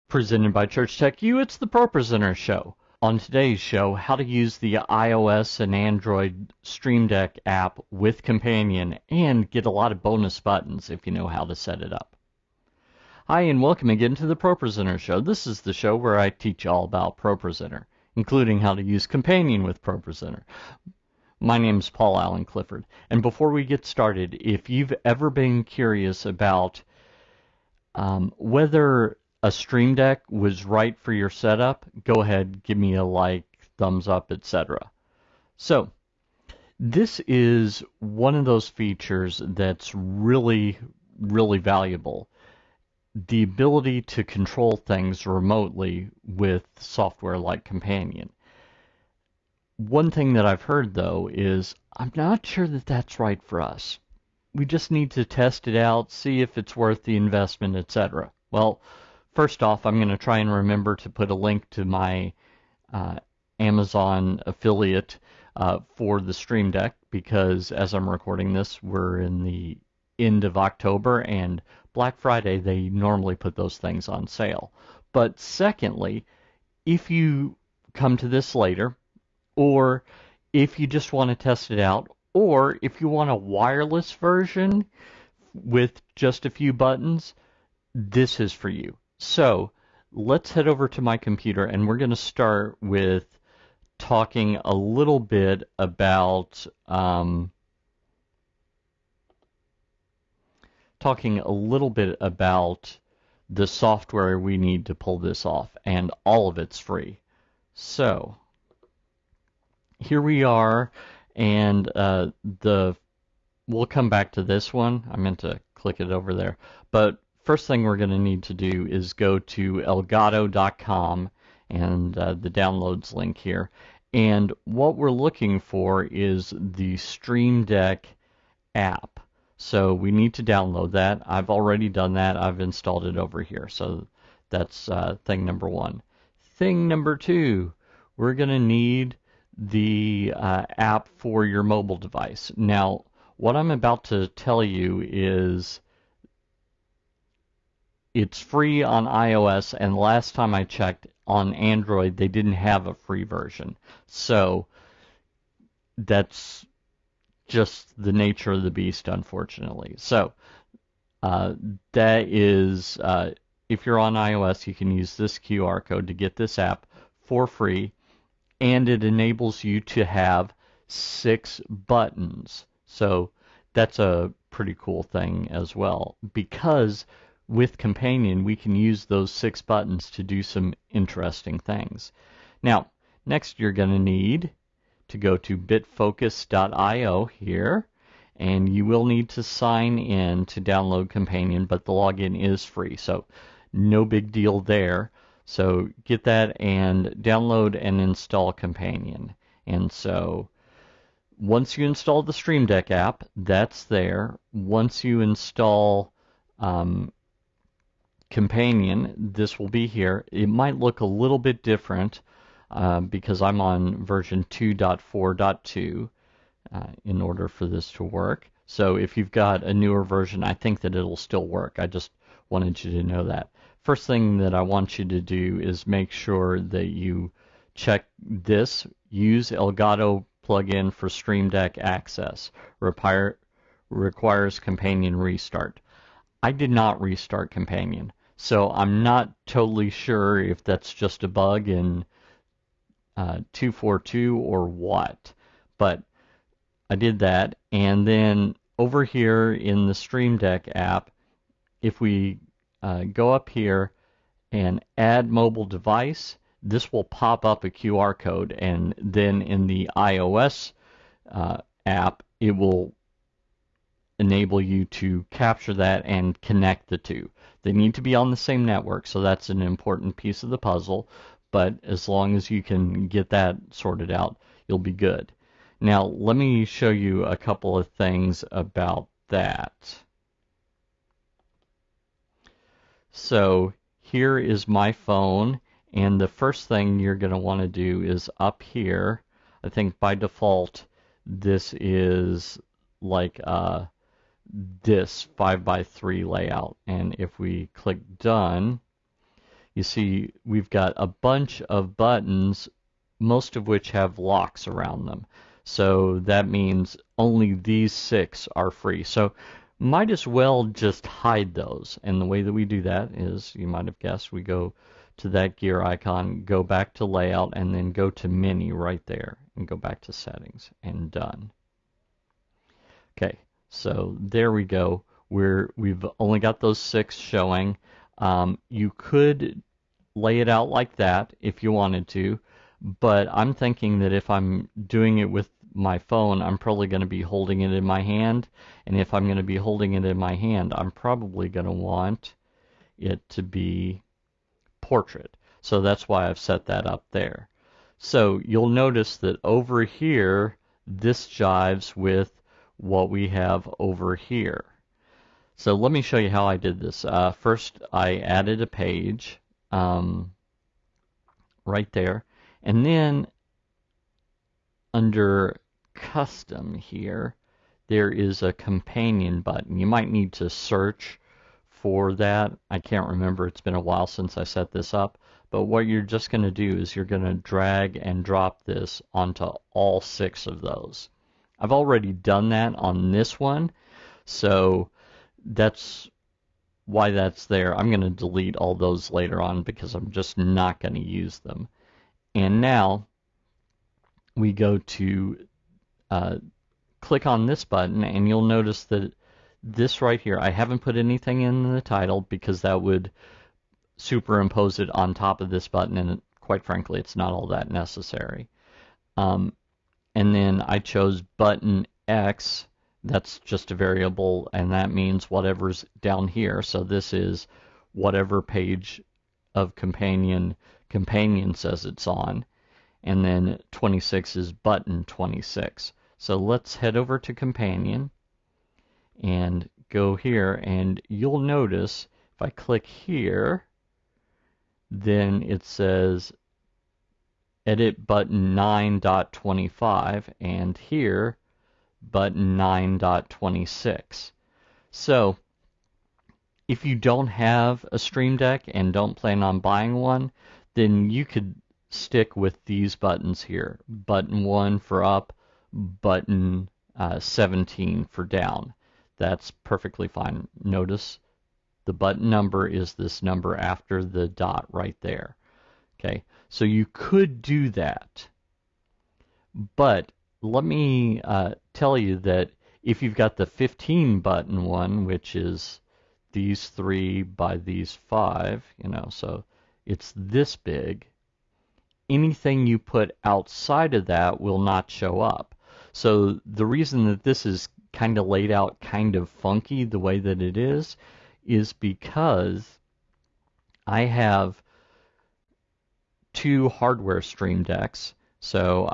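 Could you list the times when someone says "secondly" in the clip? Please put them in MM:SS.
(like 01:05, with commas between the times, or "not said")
01:15.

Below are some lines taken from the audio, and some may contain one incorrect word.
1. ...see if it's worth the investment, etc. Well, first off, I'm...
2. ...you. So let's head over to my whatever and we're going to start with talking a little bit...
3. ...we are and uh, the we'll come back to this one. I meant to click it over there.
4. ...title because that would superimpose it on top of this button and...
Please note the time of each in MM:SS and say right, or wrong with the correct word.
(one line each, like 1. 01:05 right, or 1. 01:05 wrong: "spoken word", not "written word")
1. 00:56 right
2. 01:28 wrong: "computer", not "whatever"
3. 01:50 right
4. 06:41 right.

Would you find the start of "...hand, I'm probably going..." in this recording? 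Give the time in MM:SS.
05:40.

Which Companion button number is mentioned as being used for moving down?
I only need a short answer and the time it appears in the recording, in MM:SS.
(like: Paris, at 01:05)
17, at 07:37.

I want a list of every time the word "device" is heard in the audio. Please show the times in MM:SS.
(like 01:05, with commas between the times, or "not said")
02:21, 04:15.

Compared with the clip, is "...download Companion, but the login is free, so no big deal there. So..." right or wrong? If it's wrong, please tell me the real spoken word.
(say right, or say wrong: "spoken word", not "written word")
right.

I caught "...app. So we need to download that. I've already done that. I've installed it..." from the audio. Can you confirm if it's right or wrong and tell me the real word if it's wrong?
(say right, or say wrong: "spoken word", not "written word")
right.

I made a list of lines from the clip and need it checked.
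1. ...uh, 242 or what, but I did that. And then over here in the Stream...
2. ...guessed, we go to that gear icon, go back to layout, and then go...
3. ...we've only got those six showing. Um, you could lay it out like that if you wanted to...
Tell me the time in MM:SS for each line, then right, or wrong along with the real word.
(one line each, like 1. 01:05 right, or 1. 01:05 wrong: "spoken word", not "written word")
1. 04:03 right
2. 05:13 right
3. 05:25 right.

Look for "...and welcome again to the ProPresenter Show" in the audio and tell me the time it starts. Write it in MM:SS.
00:13.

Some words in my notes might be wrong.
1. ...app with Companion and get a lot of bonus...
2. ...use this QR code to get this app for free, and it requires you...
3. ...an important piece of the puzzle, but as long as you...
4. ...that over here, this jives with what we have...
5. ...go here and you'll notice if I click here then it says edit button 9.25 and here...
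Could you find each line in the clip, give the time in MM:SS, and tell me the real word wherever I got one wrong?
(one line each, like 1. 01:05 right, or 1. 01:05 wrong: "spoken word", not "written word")
1. 00:07 right
2. 02:44 wrong: "enables", not "requires"
3. 04:29 right
4. 05:49 right
5. 07:09 right.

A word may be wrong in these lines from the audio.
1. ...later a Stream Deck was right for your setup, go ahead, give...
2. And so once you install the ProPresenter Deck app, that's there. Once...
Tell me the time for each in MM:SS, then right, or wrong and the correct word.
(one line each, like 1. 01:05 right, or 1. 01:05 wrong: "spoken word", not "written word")
1. 00:28 wrong: "whether", not "later"
2. 03:19 wrong: "Stream", not "ProPresenter".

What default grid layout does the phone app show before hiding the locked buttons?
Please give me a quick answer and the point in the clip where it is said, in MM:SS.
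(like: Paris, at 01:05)
5x3, at 04:55.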